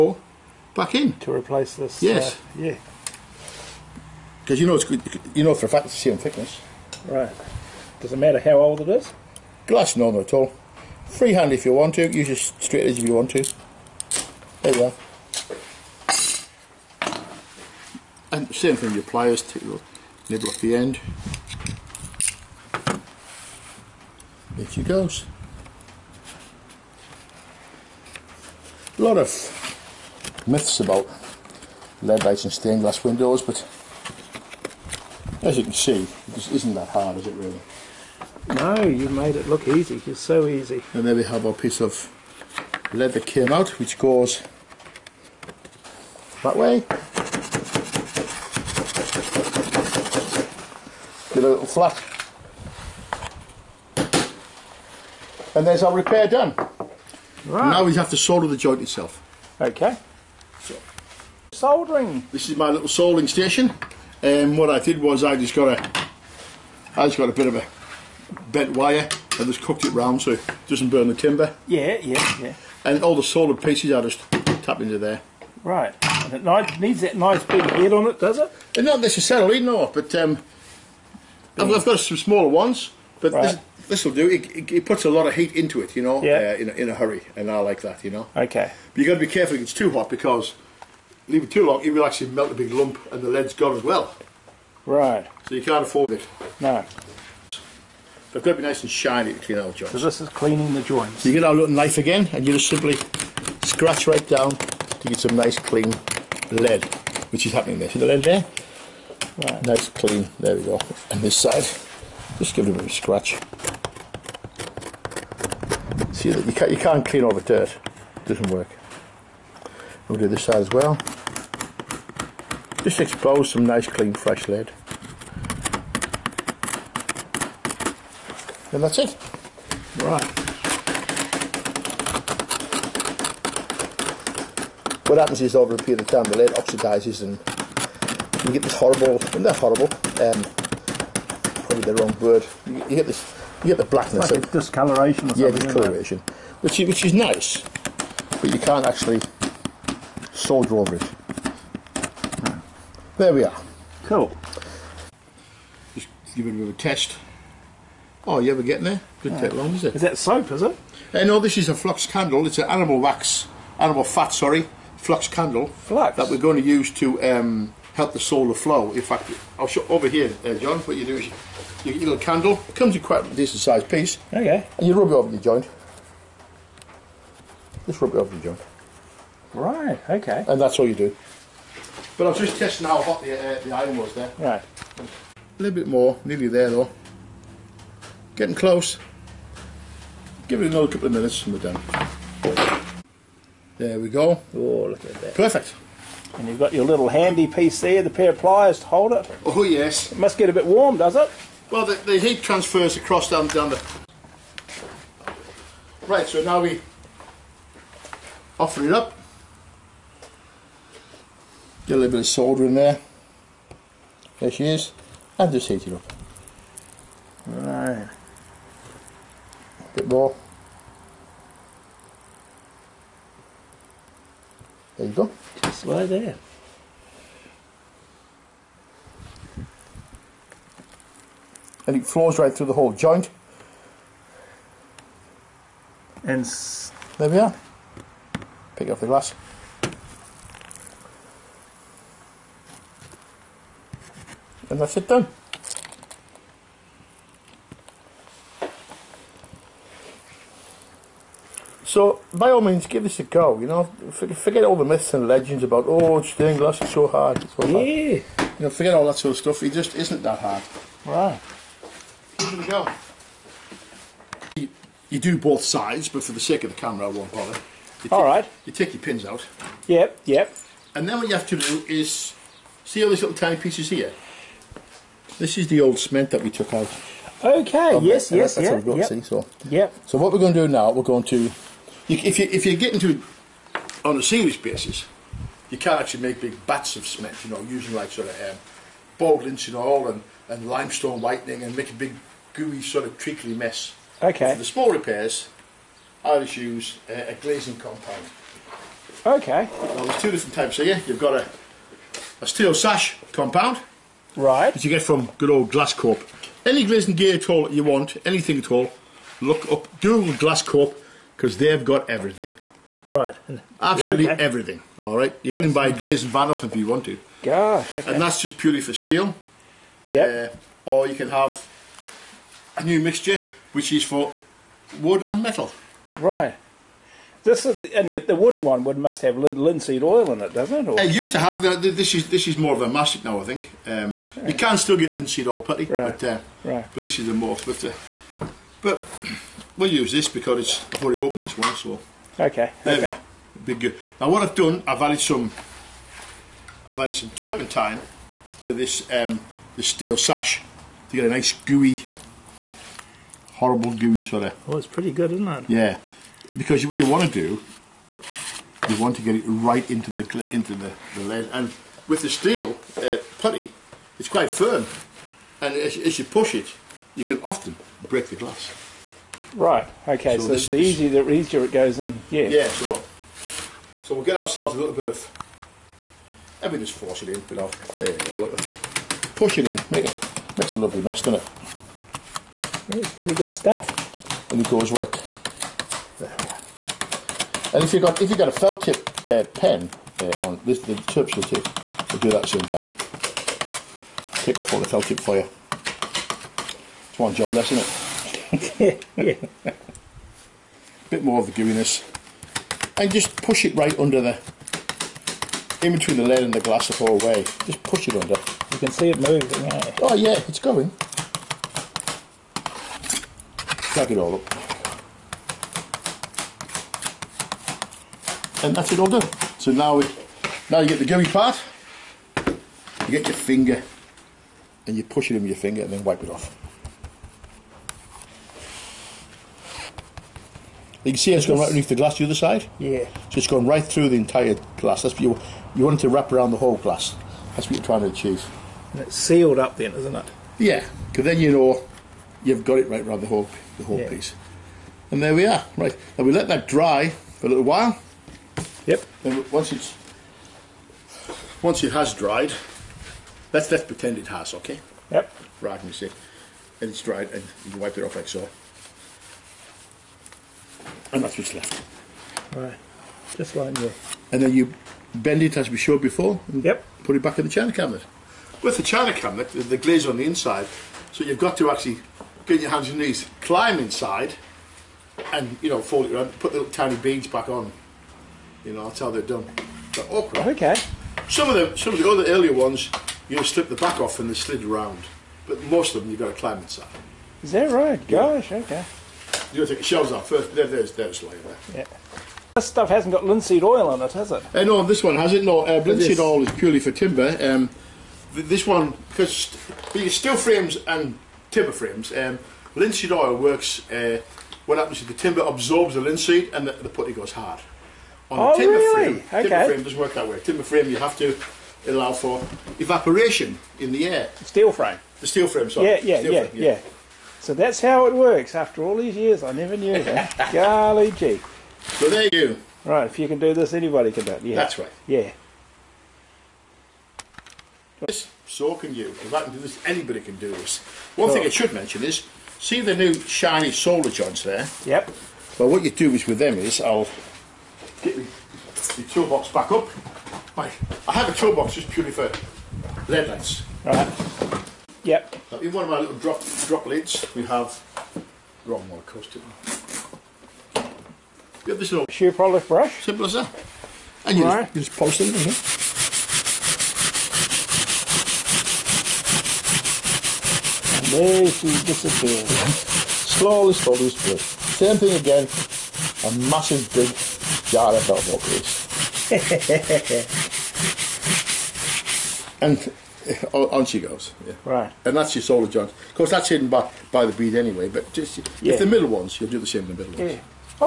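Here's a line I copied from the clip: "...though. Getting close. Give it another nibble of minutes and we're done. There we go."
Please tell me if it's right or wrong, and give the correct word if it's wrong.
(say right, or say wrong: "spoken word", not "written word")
wrong: "couple", not "nibble".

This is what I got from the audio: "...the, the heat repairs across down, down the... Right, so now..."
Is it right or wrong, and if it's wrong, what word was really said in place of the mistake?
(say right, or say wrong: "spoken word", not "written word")
wrong: "transfers", not "repairs".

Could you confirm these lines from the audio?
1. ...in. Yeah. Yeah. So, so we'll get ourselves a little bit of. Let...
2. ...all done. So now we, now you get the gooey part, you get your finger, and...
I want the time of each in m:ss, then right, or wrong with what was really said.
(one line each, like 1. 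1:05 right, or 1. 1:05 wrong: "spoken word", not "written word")
1. 6:11 right
2. 6:58 right.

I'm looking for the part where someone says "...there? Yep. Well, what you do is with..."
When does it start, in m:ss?
8:54.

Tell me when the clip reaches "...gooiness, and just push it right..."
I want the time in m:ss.
6:41.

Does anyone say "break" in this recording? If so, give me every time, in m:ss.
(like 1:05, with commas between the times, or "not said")
6:08.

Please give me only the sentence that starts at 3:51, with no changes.
and it flows right through the whole joint.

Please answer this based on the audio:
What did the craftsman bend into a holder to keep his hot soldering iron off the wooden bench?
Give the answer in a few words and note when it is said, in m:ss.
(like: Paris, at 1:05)
bent wire, at 1:08.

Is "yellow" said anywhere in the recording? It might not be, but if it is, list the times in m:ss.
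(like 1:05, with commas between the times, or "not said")
not said.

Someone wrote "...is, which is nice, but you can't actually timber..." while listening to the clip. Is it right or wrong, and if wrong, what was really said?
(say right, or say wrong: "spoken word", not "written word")
wrong: "solder", not "timber".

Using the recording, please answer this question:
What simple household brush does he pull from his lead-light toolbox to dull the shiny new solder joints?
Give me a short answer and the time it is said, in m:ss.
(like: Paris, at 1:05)
shoe polish brush, at 9:12.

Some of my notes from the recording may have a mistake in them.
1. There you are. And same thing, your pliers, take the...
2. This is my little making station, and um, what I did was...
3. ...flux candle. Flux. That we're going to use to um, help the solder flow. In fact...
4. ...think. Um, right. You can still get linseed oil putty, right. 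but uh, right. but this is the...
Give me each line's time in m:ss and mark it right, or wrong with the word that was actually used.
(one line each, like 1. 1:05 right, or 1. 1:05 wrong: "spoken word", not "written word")
1. 0:14 right
2. 1:02 wrong: "soldering", not "making"
3. 2:44 right
4. 5:33 right.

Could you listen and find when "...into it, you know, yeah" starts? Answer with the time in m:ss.
1:25.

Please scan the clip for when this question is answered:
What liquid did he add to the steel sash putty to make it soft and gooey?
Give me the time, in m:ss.
5:47.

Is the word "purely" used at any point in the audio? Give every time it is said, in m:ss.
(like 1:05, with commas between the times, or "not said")
5:18, 8:16, 9:01.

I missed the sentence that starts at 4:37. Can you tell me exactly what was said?
Okay, yes, yes, that's yeah, what we've got, yep, see, so.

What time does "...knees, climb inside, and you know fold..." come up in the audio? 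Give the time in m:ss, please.
7:52.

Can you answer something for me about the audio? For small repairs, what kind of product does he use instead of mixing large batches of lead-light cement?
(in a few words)
glazing compound.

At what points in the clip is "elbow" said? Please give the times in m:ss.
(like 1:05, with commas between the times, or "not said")
9:28.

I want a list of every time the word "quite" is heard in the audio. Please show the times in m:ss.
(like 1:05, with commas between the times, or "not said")
2:53, 6:04.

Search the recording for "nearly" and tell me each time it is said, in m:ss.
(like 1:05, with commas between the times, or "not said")
3:06.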